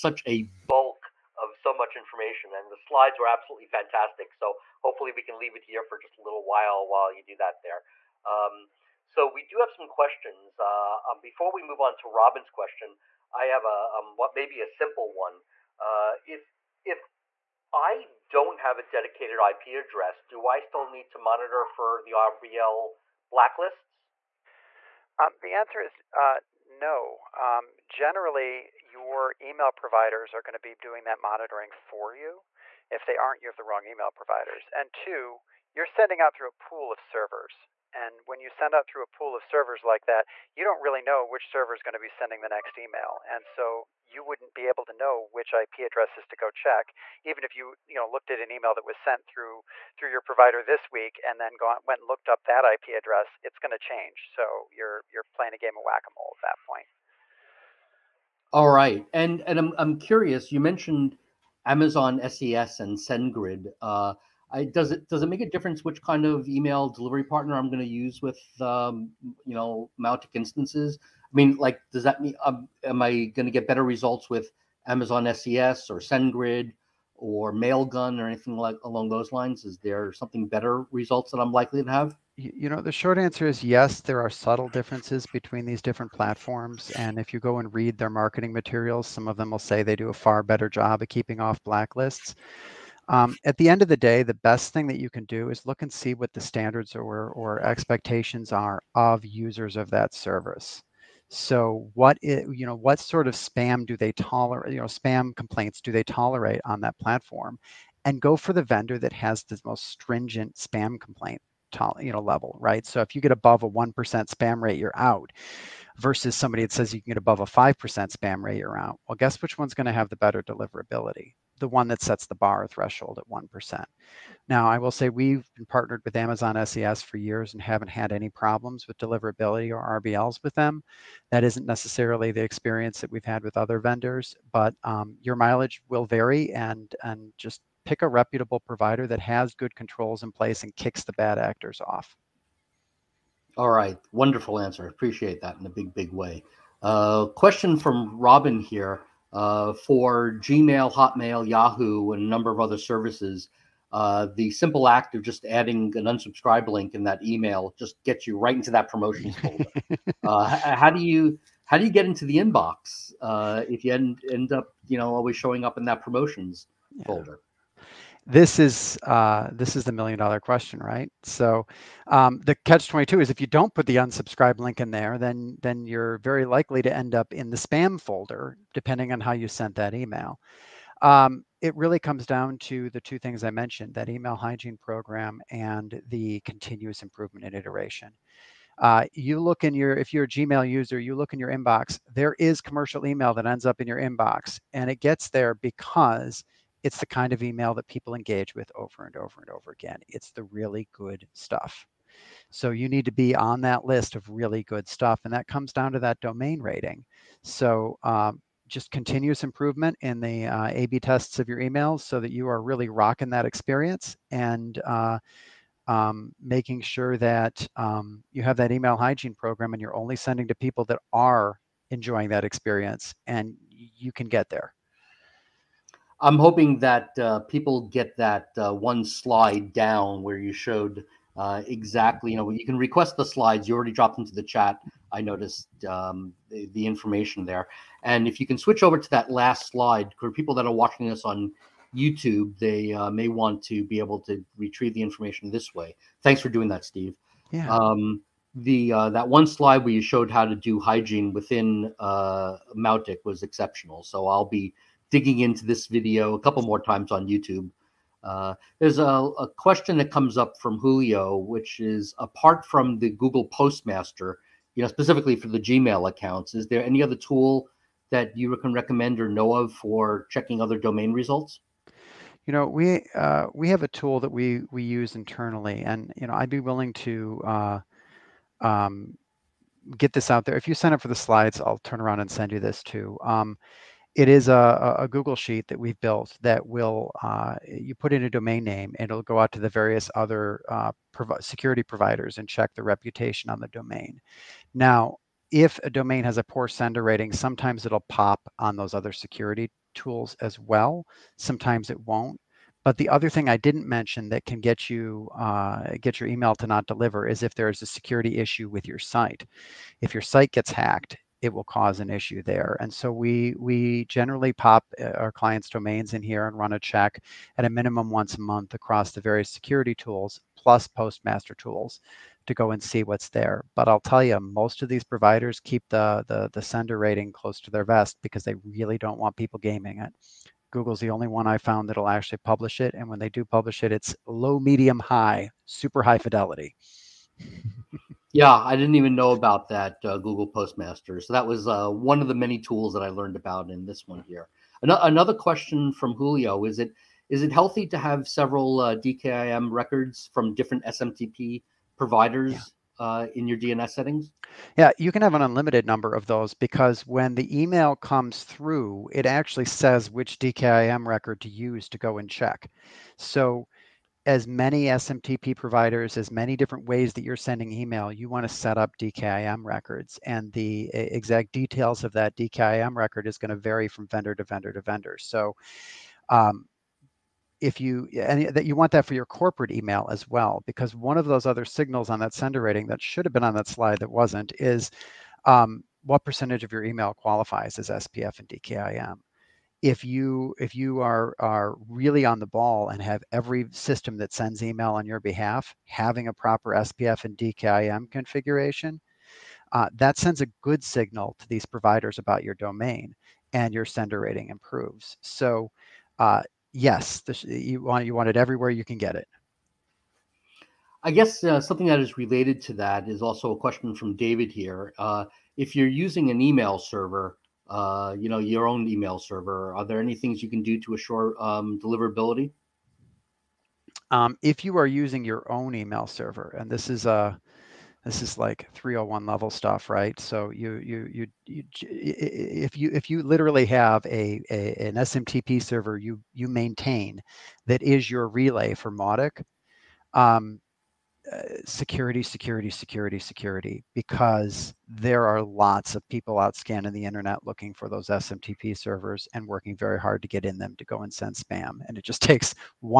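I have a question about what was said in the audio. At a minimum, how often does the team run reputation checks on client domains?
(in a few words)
once a month.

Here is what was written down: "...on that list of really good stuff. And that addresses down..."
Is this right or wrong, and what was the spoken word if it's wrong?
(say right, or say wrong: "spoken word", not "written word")
wrong: "comes", not "addresses".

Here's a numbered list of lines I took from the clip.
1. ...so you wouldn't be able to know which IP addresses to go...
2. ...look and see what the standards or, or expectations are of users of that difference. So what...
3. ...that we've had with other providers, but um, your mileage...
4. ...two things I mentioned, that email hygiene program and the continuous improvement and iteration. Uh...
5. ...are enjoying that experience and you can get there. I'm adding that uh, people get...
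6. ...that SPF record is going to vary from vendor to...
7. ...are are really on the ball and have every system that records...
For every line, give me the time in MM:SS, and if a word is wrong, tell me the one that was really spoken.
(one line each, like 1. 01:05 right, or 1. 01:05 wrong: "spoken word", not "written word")
1. 00:43 right
2. 01:35 wrong: "service", not "difference"
3. 02:12 wrong: "vendors", not "providers"
4. 03:02 right
5. 03:41 wrong: "hoping", not "adding"
6. 06:12 wrong: "DKIM", not "SPF"
7. 06:31 wrong: "sends", not "records".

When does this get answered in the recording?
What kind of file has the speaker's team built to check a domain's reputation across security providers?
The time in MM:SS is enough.
04:45.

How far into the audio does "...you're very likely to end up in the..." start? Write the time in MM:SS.
02:55.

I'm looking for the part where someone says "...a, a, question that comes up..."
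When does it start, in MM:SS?
04:18.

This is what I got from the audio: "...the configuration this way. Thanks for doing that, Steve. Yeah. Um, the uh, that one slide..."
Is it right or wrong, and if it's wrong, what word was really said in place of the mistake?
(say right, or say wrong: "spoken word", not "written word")
wrong: "information", not "configuration".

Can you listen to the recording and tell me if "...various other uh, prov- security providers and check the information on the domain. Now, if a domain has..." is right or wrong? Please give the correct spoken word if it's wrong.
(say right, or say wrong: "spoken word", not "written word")
wrong: "reputation", not "information".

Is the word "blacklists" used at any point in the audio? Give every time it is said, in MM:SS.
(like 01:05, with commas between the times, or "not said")
00:23, 01:31.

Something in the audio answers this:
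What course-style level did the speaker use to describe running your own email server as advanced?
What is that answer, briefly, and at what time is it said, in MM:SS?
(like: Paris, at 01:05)
301 level, at 07:08.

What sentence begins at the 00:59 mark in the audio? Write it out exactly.
And and I'm I'm curious, you mentioned Amazon SES and SendGrid.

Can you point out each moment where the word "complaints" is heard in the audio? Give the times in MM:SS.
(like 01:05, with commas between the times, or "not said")
01:45, 01:50.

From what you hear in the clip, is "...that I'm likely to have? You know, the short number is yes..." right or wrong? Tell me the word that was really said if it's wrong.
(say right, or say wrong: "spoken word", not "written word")
wrong: "answer", not "number".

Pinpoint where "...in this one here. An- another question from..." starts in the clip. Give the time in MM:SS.
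05:43.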